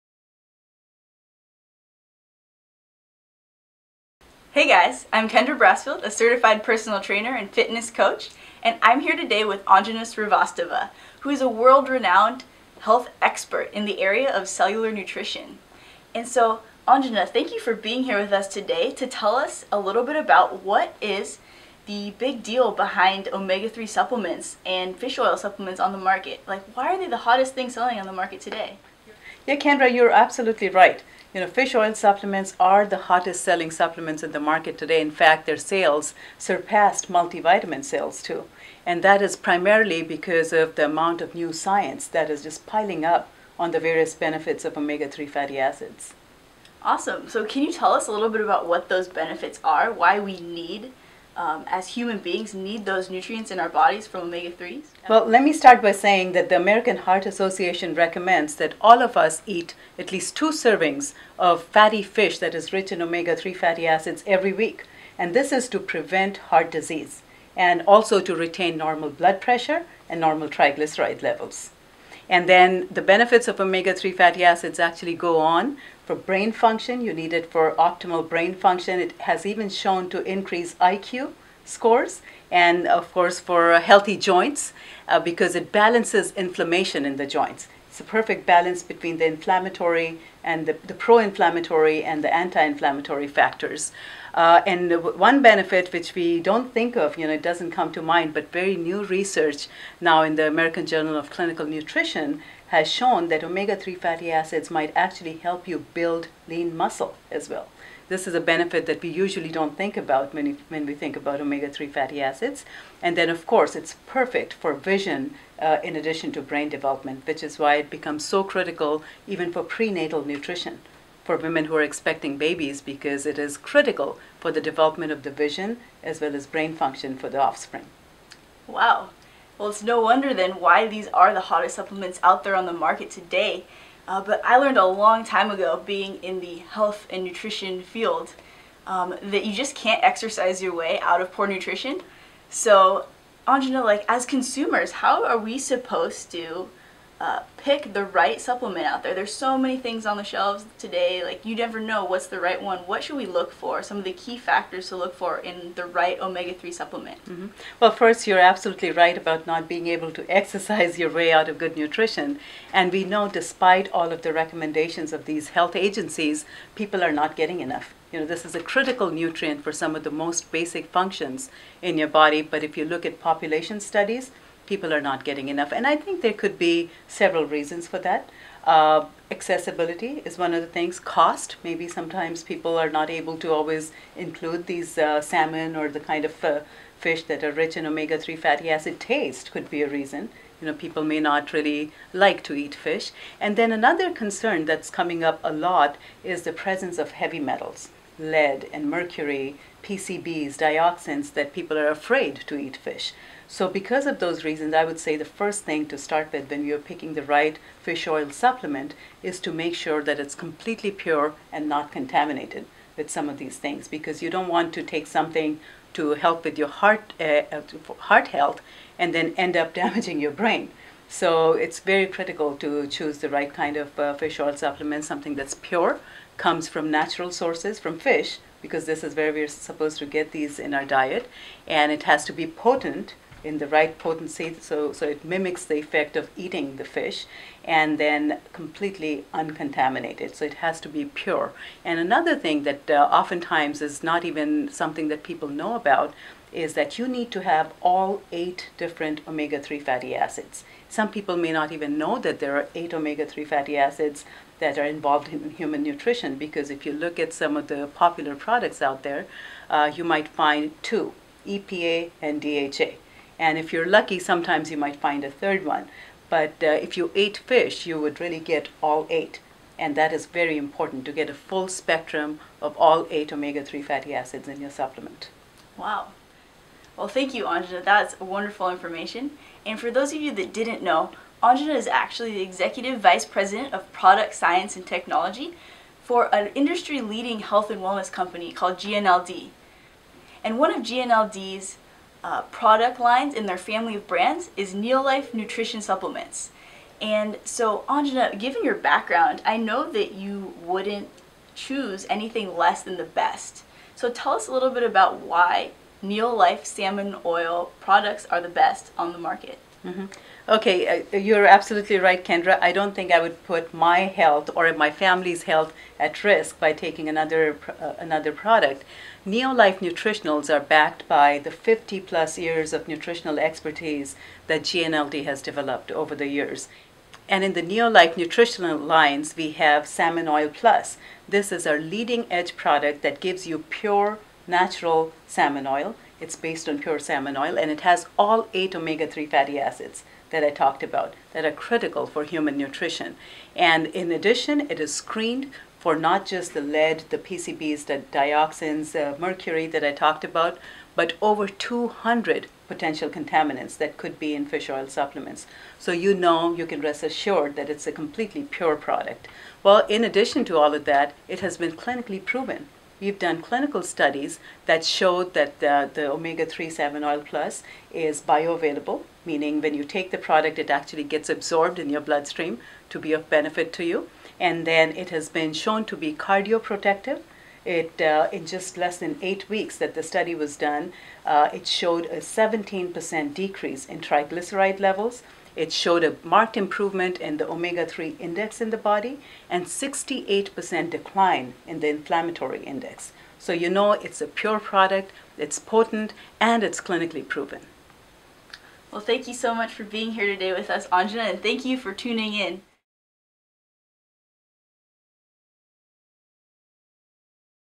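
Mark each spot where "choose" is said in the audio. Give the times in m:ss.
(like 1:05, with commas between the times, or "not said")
3:42, 5:01.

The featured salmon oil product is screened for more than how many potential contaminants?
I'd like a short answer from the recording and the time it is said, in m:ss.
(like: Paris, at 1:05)
200, at 5:51.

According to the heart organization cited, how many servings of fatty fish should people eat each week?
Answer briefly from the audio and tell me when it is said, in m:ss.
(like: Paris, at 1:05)
2, at 1:00.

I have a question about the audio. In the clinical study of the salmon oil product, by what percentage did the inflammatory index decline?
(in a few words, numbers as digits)
68%.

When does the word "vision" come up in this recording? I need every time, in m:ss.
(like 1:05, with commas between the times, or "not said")
1:54, 2:05.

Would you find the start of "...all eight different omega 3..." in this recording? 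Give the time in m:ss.
4:07.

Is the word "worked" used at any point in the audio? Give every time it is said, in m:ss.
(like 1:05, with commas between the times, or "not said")
not said.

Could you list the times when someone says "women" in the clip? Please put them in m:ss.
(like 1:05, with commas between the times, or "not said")
2:01.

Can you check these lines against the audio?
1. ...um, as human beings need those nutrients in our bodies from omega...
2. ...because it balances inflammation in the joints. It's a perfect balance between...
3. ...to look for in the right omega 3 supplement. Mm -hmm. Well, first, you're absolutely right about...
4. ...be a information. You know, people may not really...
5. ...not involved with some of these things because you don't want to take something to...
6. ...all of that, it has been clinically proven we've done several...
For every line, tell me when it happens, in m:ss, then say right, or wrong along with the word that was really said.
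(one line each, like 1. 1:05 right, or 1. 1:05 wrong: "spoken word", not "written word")
1. 0:51 right
2. 1:25 right
3. 2:34 right
4. 3:09 wrong: "reason", not "information"
5. 3:31 wrong: "contaminated", not "involved"
6. 6:00 wrong: "clinical", not "several".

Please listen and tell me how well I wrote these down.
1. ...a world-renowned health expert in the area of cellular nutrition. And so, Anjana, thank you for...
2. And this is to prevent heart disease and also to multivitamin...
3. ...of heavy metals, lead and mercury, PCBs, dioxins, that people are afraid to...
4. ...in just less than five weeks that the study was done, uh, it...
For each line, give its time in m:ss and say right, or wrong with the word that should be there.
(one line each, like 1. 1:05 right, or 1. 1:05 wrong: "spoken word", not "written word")
1. 0:11 right
2. 1:05 wrong: "retain", not "multivitamin"
3. 3:16 right
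4. 6:18 wrong: "eight", not "five".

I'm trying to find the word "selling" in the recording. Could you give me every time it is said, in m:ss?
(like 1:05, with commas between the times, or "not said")
0:27, 0:33.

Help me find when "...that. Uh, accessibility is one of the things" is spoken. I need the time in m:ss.
2:58.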